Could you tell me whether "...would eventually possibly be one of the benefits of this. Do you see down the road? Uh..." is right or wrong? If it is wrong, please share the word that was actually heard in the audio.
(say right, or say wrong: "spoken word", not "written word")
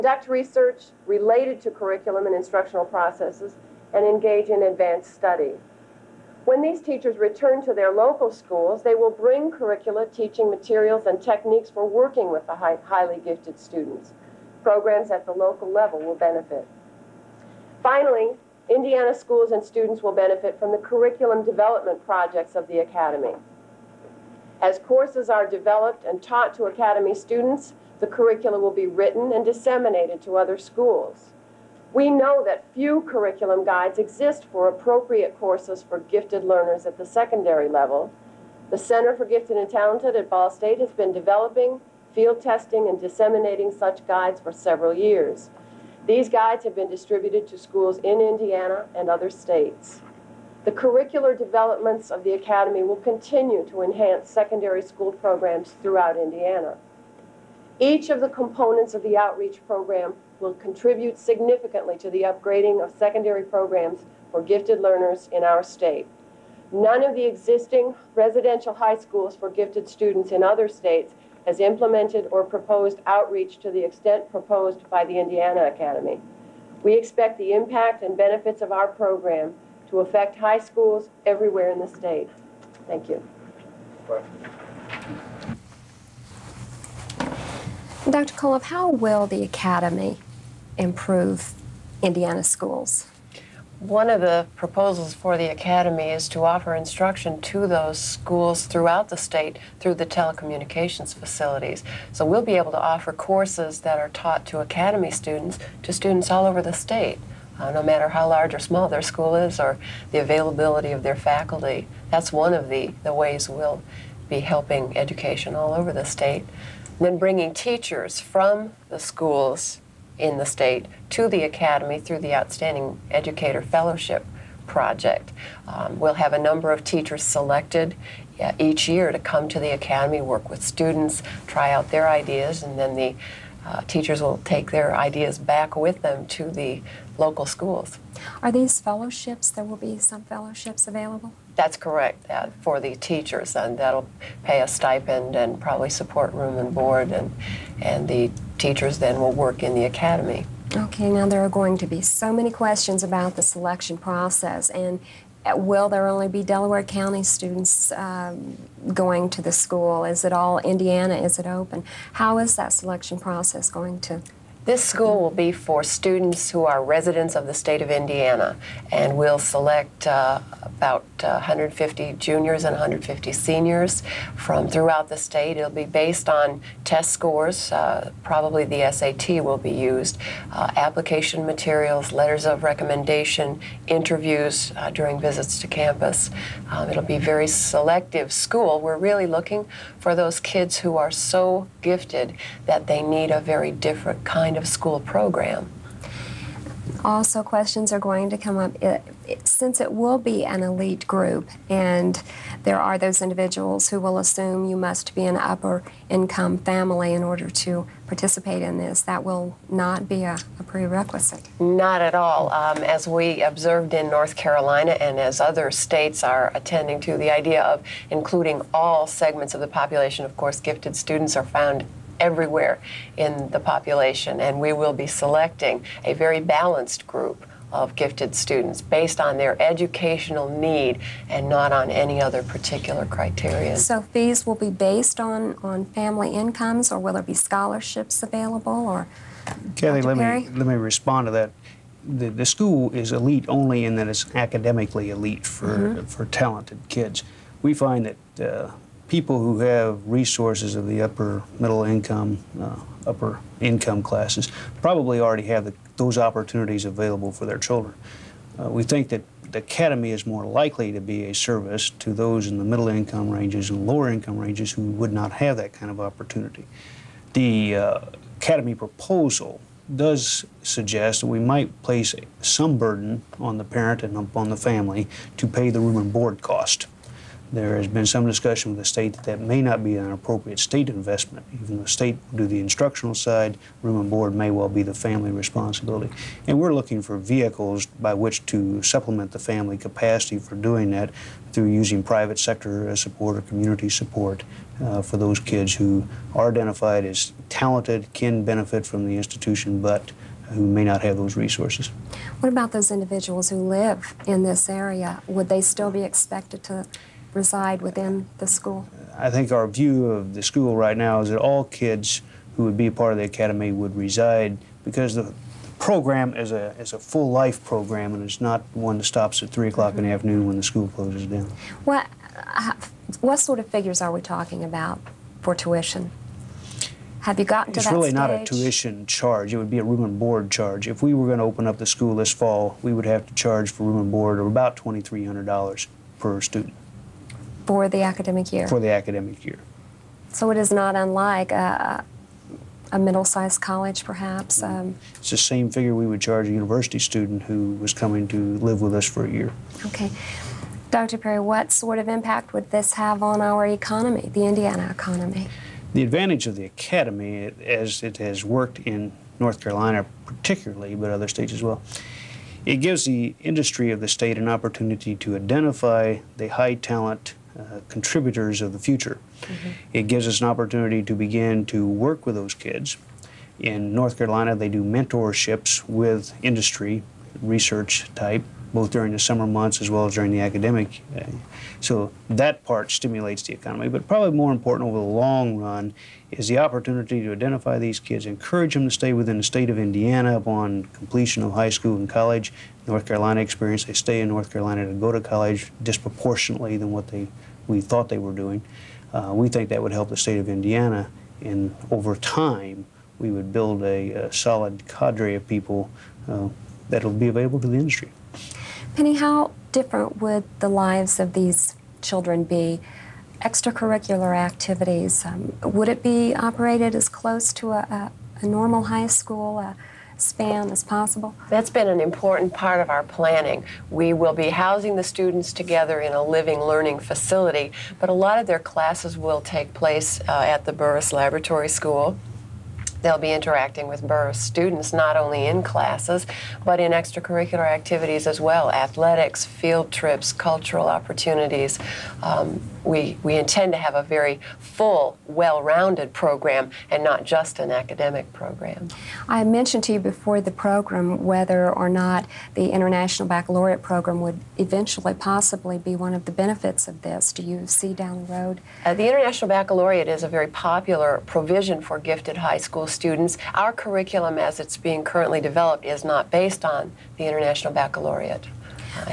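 right.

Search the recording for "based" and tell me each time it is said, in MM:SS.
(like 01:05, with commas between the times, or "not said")
02:55, 03:48, 03:54, 07:46.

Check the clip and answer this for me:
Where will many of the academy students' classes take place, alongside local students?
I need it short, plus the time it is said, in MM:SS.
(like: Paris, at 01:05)
Burris Laboratory School, at 07:10.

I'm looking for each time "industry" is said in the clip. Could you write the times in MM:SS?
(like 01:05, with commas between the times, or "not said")
06:03, 06:16, 06:47.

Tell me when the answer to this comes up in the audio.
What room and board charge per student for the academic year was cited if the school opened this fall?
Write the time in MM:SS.
05:34.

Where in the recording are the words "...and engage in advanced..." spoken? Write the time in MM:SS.
00:03.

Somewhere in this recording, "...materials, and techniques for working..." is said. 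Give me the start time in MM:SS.
00:10.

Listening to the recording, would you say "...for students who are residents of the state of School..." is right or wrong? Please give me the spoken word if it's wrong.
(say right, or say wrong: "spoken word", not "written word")
wrong: "Indiana", not "School".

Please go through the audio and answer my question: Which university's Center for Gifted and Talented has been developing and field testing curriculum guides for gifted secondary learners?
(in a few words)
Ball State.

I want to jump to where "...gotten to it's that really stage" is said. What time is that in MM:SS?
05:27.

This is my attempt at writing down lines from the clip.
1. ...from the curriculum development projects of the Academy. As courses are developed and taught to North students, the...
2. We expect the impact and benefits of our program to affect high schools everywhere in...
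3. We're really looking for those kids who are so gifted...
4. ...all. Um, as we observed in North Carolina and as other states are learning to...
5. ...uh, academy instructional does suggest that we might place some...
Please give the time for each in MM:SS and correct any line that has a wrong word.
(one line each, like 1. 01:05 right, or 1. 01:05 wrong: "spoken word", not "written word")
1. 00:20 wrong: "Academy", not "North"
2. 01:16 right
3. 03:08 right
4. 03:32 wrong: "attending", not "learning"
5. 04:27 wrong: "proposal", not "instructional".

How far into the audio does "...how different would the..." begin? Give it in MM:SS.
06:49.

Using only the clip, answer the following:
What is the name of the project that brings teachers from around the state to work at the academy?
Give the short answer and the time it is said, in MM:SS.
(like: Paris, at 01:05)
Outstanding Educator Fellowship Project, at 02:02.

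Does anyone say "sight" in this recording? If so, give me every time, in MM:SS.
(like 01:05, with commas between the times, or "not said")
not said.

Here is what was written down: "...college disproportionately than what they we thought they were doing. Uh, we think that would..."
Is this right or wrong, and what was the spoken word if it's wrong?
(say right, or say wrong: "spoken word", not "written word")
right.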